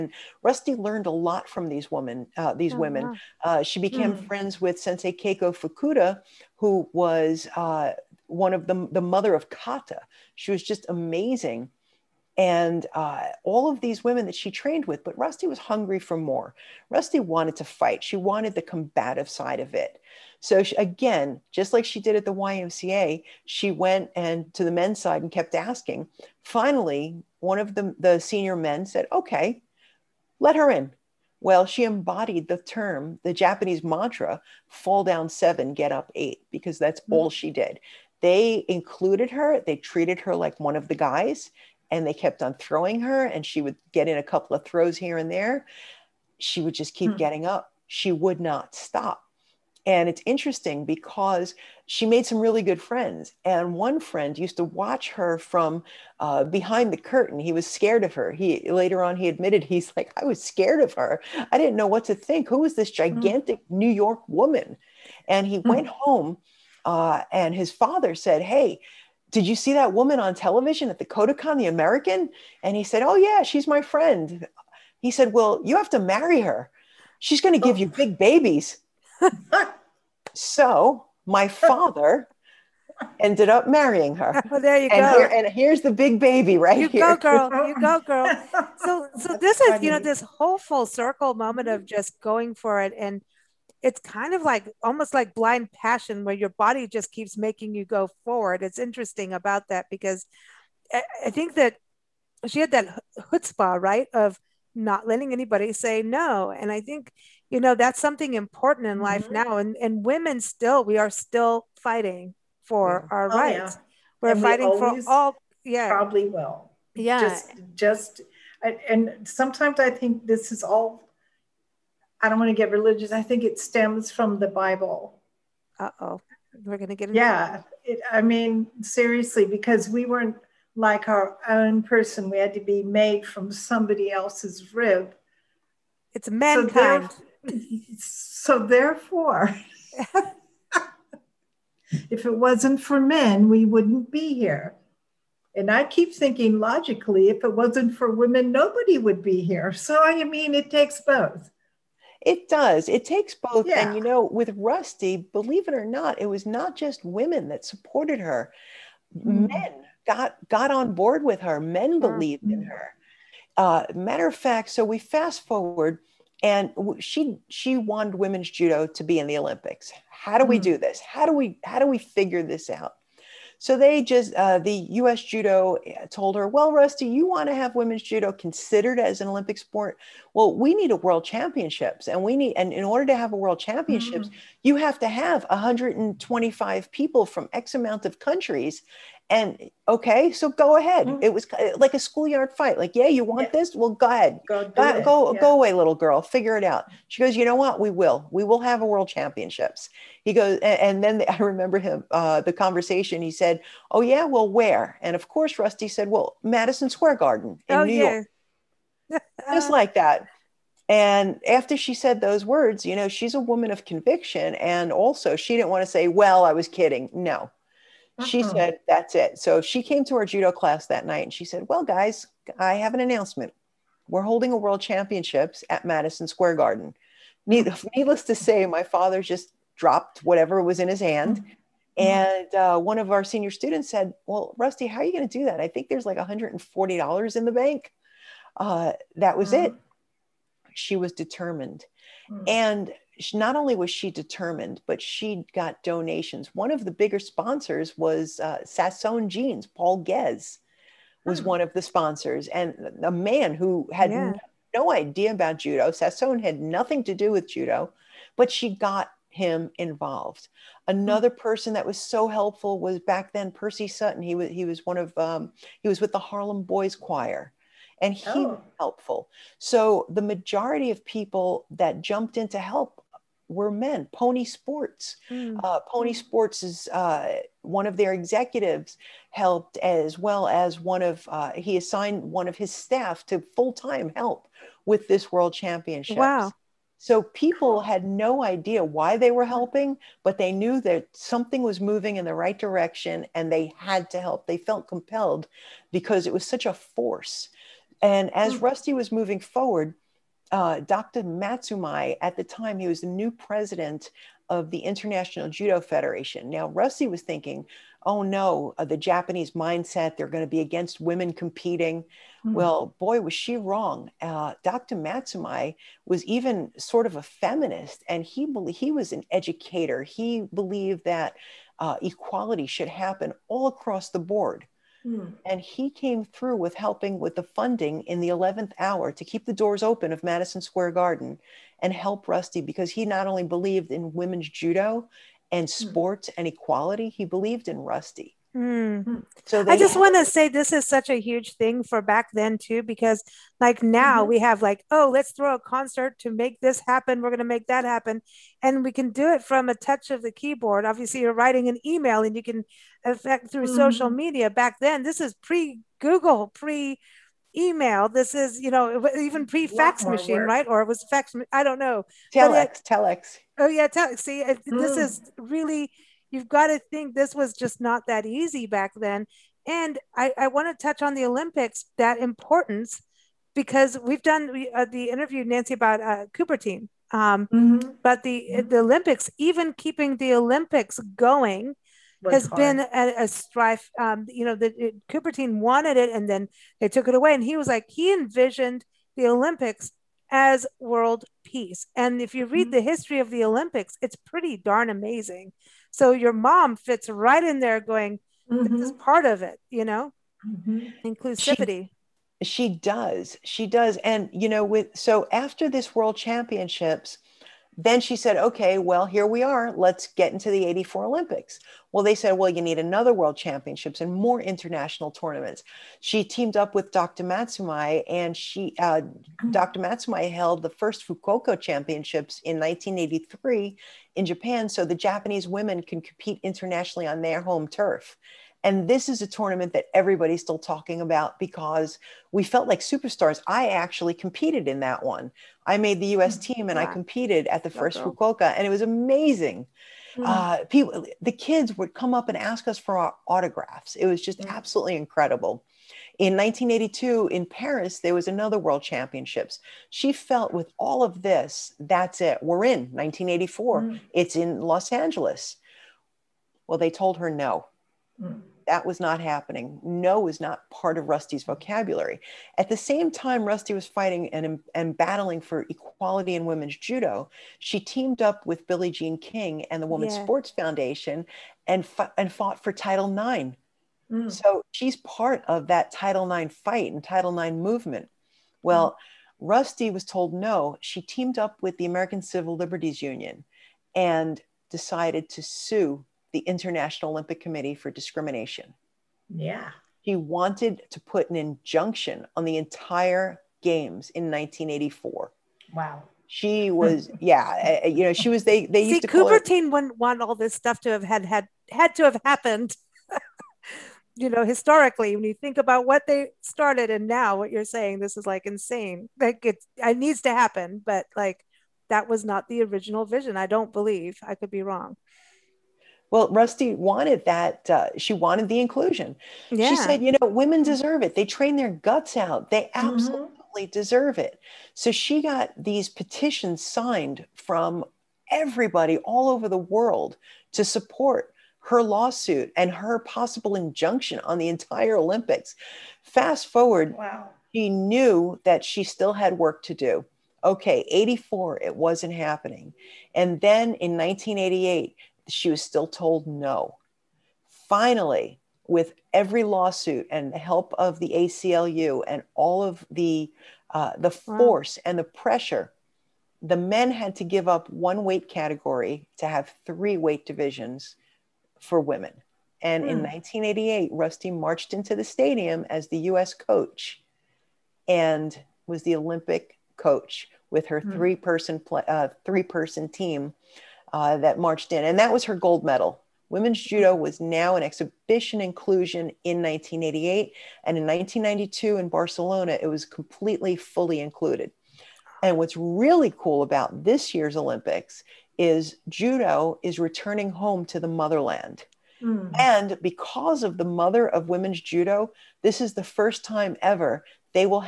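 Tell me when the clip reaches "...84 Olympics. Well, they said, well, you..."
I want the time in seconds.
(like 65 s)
410 s.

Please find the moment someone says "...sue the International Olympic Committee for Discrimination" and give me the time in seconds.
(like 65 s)
485 s.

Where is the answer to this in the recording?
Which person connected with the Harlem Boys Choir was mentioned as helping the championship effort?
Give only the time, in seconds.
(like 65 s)
263 s.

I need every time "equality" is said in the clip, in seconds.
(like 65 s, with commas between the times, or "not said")
322 s, 336 s, 465 s.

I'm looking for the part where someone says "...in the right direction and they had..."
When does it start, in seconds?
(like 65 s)
292 s.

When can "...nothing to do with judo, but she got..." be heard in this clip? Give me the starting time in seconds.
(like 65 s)
256 s.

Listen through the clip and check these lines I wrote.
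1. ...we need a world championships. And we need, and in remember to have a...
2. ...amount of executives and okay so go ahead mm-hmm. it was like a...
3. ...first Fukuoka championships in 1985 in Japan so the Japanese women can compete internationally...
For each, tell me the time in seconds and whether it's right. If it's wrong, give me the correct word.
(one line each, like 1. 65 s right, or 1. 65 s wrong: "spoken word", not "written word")
1. 180 s wrong: "order", not "remember"
2. 187 s wrong: "countries", not "executives"
3. 420 s wrong: "1983", not "1985".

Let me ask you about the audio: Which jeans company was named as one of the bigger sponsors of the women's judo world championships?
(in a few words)
Sasson Jeans.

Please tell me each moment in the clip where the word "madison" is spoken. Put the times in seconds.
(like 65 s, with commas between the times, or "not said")
206 s, 225 s, 330 s.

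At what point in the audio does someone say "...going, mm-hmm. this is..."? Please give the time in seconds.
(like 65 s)
397 s.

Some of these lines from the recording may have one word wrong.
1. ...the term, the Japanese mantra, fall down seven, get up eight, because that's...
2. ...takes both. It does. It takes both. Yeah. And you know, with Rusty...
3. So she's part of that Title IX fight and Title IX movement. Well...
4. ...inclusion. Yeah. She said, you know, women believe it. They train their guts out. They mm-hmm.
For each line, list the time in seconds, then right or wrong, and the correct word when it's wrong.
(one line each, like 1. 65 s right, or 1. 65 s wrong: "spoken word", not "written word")
1. 32 s right
2. 150 s right
3. 474 s right
4. 518 s wrong: "deserve", not "believe".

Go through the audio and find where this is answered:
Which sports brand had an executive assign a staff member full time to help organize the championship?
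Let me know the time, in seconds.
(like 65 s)
274 s.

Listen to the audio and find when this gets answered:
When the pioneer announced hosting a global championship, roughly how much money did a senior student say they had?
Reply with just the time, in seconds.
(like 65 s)
236 s.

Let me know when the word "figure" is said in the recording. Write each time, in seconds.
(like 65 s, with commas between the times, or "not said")
171 s, 196 s.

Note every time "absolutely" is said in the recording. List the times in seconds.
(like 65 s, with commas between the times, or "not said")
444 s, 522 s.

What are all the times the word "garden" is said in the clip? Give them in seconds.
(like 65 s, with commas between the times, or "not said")
207 s, 226 s, 330 s.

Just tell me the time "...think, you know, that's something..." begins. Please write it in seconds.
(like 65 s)
106 s.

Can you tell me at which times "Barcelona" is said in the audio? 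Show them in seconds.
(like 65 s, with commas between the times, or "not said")
581 s.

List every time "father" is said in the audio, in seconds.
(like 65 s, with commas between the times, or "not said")
67 s, 81 s, 228 s.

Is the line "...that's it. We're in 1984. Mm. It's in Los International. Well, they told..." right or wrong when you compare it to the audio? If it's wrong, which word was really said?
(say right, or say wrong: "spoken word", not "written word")
wrong: "Angeles", not "International".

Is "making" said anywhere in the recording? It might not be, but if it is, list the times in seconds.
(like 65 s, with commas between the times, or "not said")
97 s.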